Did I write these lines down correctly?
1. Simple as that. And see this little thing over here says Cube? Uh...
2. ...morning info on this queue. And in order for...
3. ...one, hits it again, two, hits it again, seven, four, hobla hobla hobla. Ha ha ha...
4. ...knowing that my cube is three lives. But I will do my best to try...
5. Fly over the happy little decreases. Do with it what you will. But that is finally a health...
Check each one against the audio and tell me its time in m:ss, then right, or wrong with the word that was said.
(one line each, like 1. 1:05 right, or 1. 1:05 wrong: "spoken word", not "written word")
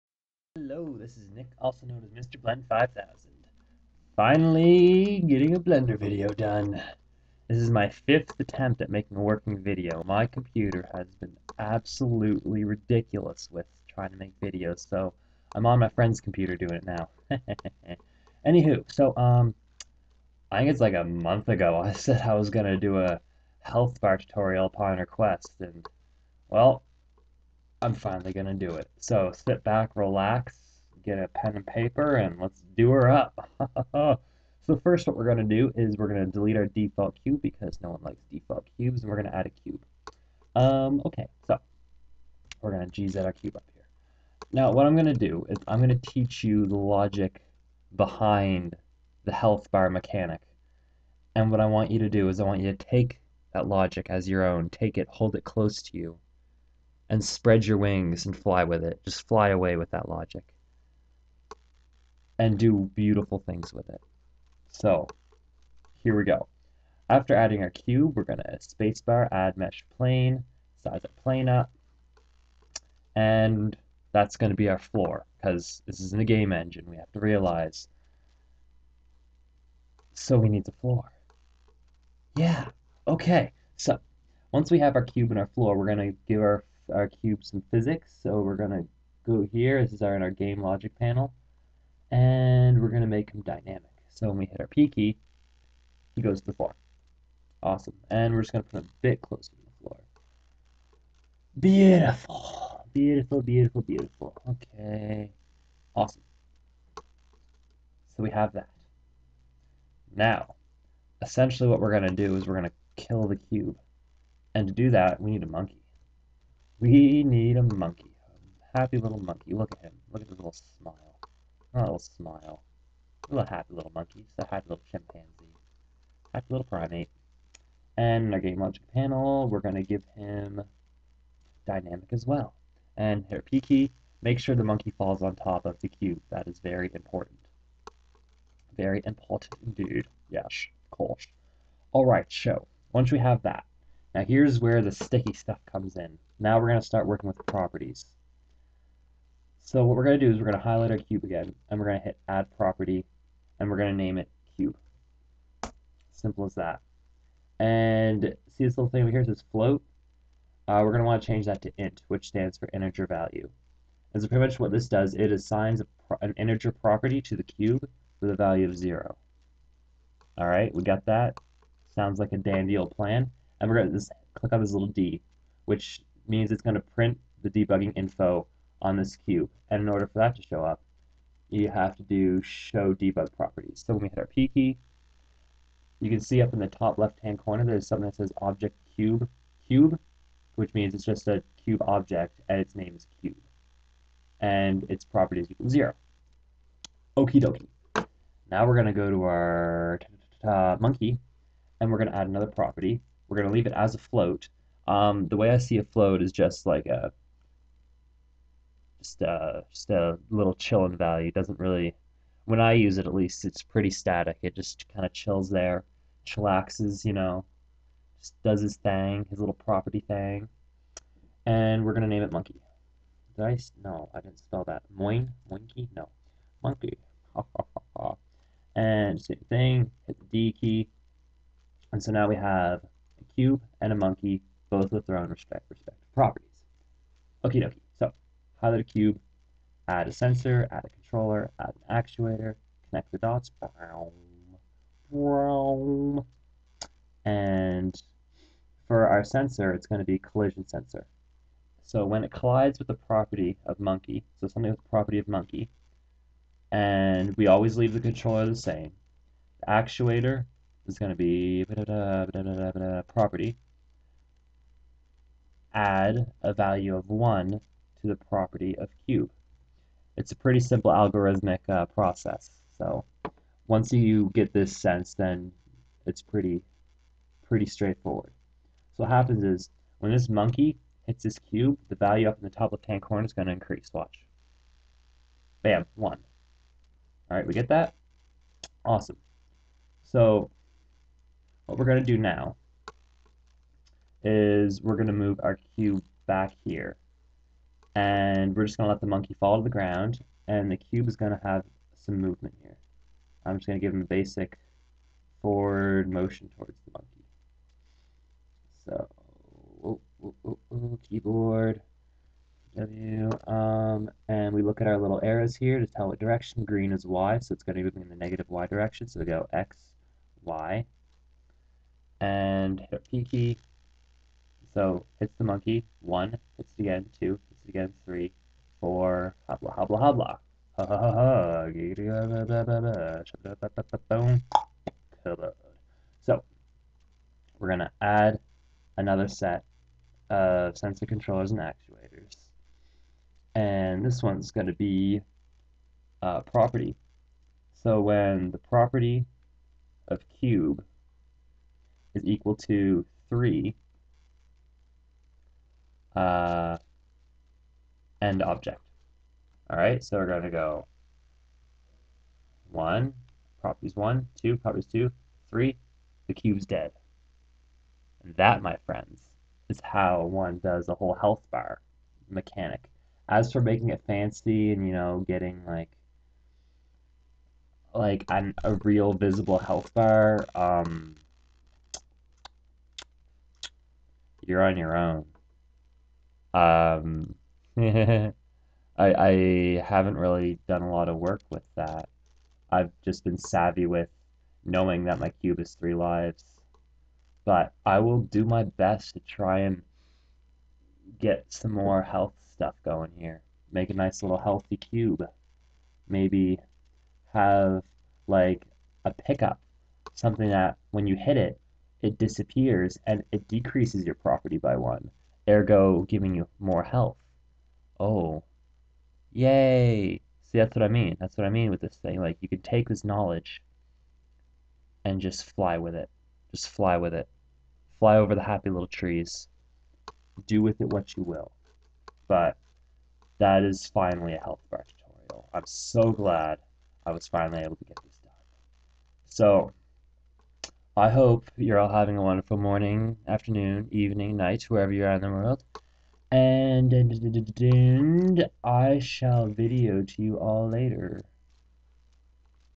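1. 2:36 wrong: "Float", not "Cube"
2. 2:57 wrong: "debugging", not "morning"
3. 5:25 wrong: "three", not "seven"
4. 6:34 right
5. 7:07 wrong: "trees", not "decreases".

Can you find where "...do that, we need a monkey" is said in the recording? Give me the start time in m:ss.
1:54.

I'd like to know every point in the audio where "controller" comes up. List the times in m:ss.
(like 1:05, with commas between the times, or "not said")
4:00, 4:17, 5:41.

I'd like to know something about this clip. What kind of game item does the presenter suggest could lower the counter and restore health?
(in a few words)
a pickup.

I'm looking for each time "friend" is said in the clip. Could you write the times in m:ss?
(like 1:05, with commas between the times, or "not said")
0:15, 6:08.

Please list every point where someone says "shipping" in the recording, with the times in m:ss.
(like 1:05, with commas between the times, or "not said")
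not said.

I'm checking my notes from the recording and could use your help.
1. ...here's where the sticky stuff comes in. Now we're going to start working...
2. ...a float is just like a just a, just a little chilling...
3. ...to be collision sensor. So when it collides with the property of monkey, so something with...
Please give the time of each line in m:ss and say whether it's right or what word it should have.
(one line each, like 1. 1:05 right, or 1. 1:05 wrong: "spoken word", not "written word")
1. 2:24 right
2. 3:25 right
3. 4:09 right.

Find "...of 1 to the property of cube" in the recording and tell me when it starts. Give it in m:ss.
4:26.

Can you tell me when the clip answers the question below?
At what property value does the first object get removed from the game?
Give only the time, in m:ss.
5:52.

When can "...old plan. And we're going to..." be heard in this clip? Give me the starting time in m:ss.
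2:52.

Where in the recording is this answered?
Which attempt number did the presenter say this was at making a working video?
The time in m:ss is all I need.
0:07.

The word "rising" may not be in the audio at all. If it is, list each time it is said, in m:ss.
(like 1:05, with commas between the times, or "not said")
not said.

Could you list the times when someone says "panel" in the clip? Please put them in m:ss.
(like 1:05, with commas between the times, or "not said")
1:30, 2:08.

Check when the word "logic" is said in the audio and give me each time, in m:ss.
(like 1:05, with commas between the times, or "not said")
0:46, 0:53, 1:00, 1:30, 2:08.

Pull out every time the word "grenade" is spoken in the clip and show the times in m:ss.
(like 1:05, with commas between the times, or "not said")
not said.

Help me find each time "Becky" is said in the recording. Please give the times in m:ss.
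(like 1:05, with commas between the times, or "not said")
not said.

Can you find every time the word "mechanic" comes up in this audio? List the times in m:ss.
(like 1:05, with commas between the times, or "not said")
0:49, 6:12.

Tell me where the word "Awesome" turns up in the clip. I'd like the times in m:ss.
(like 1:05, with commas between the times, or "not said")
1:37, 1:45, 4:48.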